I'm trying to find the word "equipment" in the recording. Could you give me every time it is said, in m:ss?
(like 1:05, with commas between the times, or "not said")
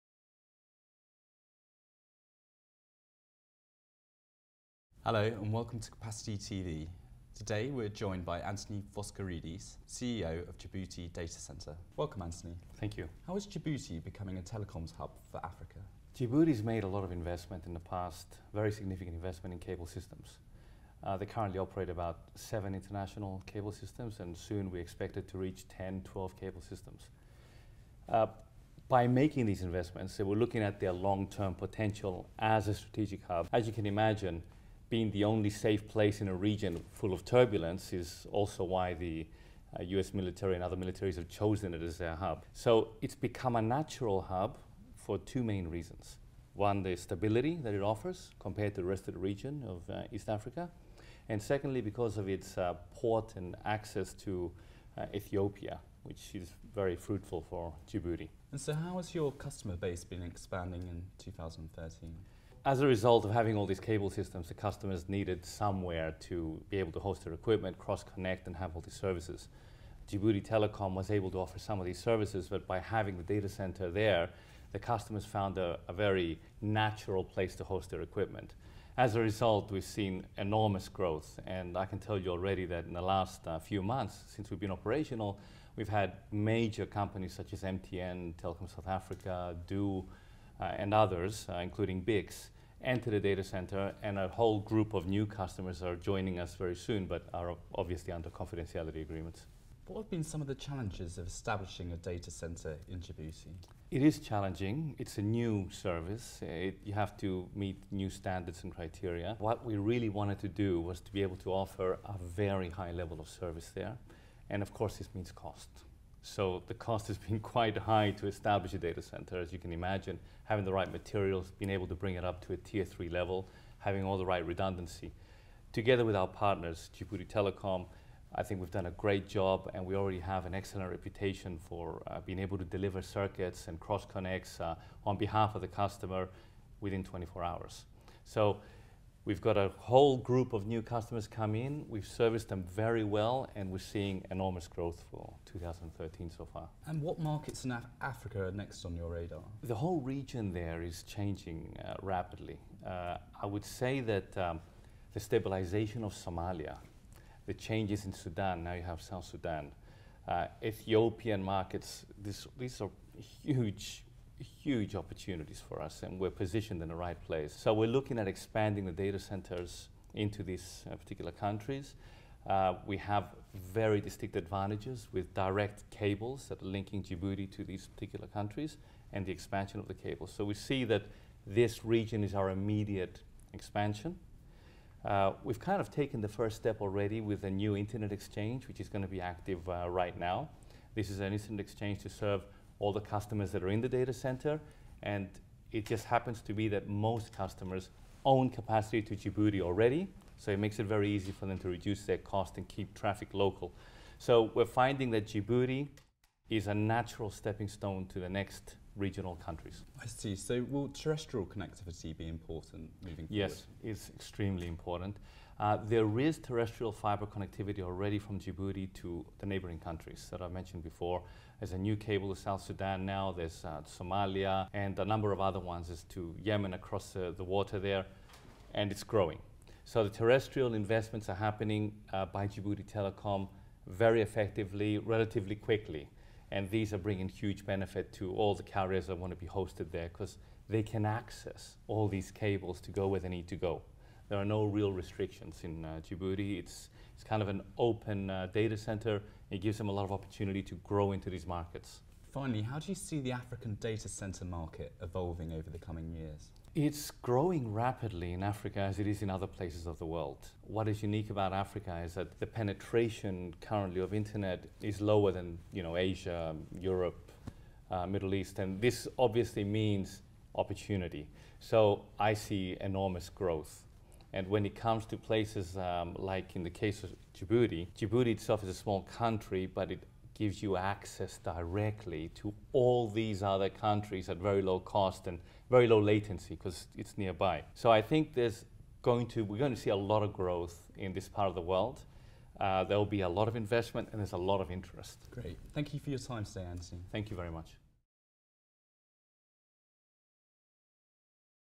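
1:07, 1:18.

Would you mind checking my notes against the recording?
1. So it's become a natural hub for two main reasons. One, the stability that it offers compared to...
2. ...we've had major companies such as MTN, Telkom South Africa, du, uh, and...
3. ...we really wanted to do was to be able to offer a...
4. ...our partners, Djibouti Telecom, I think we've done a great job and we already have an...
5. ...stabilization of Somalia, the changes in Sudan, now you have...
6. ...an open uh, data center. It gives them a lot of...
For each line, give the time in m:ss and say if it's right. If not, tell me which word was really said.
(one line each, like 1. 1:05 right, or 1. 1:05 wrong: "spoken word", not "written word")
1. 0:42 right
2. 1:25 right
3. 1:49 right
4. 2:06 right
5. 2:35 right
6. 4:07 right.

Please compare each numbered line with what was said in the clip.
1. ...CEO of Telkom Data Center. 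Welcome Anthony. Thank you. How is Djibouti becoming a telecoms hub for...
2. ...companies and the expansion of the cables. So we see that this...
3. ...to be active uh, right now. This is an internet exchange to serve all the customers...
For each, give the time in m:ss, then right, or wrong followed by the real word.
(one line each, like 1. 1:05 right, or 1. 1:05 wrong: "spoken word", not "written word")
1. 0:09 wrong: "Djibouti", not "Telkom"
2. 2:58 wrong: "countries", not "companies"
3. 3:09 right.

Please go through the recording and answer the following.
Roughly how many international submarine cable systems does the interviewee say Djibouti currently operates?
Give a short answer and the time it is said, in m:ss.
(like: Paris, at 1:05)
7, at 0:22.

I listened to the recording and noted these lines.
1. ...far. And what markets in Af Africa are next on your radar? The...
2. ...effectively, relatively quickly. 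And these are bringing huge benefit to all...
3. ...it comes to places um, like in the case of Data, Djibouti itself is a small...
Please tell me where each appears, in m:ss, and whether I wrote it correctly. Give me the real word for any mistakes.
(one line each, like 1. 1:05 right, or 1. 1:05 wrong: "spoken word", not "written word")
1. 2:26 right
2. 3:54 right
3. 4:34 wrong: "Djibouti", not "Data".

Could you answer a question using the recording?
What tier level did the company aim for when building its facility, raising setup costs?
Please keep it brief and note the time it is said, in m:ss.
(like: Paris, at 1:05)
Tier 3, at 2:02.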